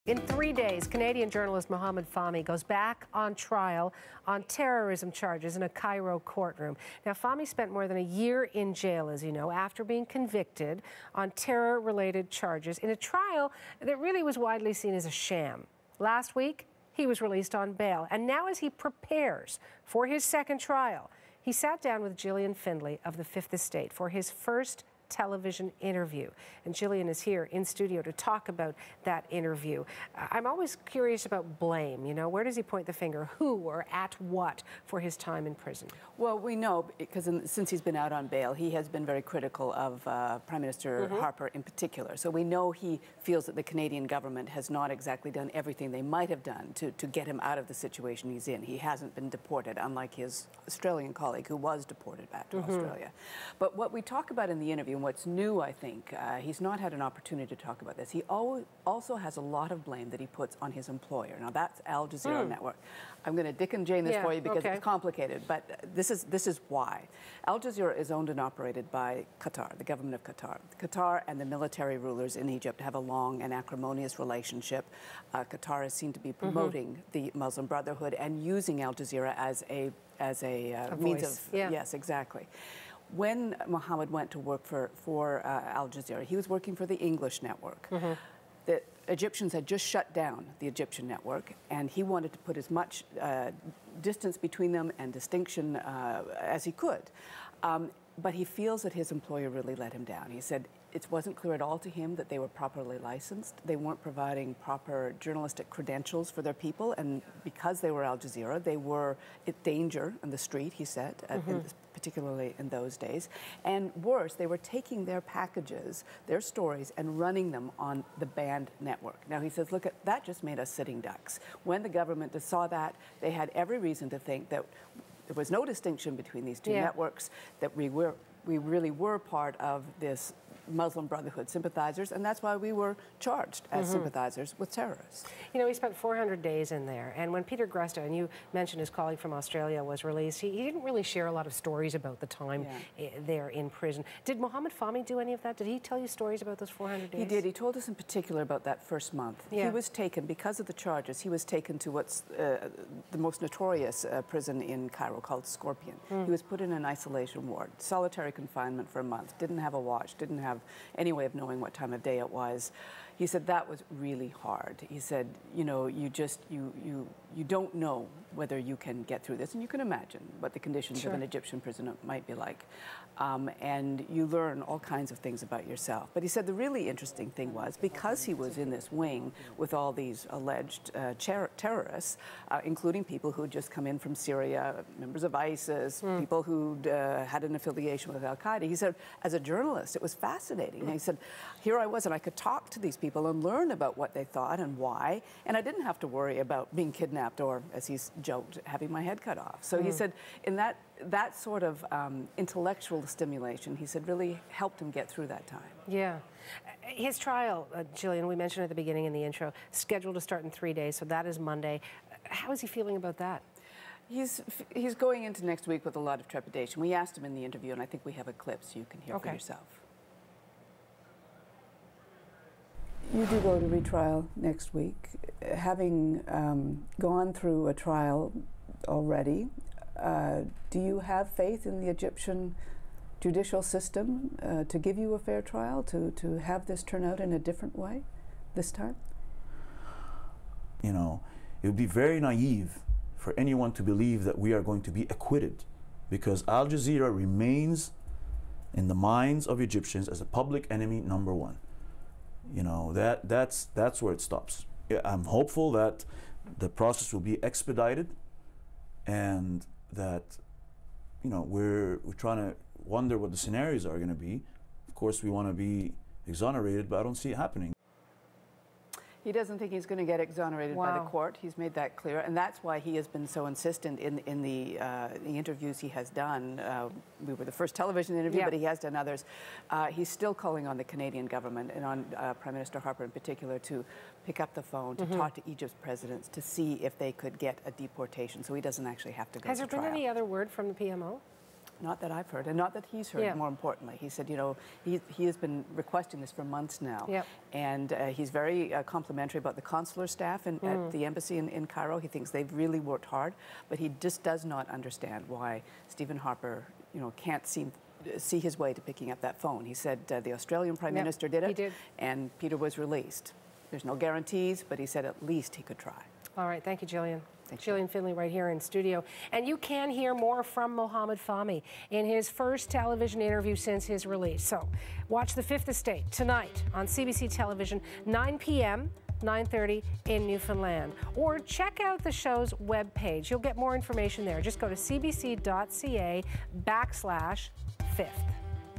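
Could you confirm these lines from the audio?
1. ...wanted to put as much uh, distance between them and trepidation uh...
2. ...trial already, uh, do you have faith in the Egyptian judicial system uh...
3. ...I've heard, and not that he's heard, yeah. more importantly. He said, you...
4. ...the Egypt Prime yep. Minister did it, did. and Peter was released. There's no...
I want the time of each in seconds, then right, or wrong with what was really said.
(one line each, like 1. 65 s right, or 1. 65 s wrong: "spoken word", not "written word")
1. 92 s wrong: "distinction", not "trepidation"
2. 227 s right
3. 292 s right
4. 310 s wrong: "Australian", not "Egypt".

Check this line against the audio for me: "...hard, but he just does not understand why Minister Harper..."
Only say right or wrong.
wrong.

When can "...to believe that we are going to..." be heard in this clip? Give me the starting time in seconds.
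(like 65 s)
243 s.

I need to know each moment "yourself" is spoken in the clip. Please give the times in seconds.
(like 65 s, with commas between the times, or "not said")
175 s, 219 s.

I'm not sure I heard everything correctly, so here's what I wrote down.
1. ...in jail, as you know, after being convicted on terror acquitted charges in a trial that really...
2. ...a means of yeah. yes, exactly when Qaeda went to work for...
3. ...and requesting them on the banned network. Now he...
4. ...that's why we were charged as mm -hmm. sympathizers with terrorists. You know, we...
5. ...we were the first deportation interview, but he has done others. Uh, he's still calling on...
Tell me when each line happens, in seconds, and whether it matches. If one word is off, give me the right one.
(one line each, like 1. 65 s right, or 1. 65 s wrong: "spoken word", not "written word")
1. 8 s wrong: "related", not "acquitted"
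2. 80 s wrong: "Mohamed", not "Qaeda"
3. 116 s wrong: "running", not "requesting"
4. 132 s right
5. 277 s wrong: "television", not "deportation".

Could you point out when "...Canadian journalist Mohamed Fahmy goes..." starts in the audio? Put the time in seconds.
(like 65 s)
0 s.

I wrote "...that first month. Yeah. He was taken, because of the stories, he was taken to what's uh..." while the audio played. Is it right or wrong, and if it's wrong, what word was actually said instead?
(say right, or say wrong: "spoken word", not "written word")
wrong: "charges", not "stories".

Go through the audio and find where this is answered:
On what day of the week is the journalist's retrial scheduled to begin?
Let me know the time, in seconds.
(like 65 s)
211 s.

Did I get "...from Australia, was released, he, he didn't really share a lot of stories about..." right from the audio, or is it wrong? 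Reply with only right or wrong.
right.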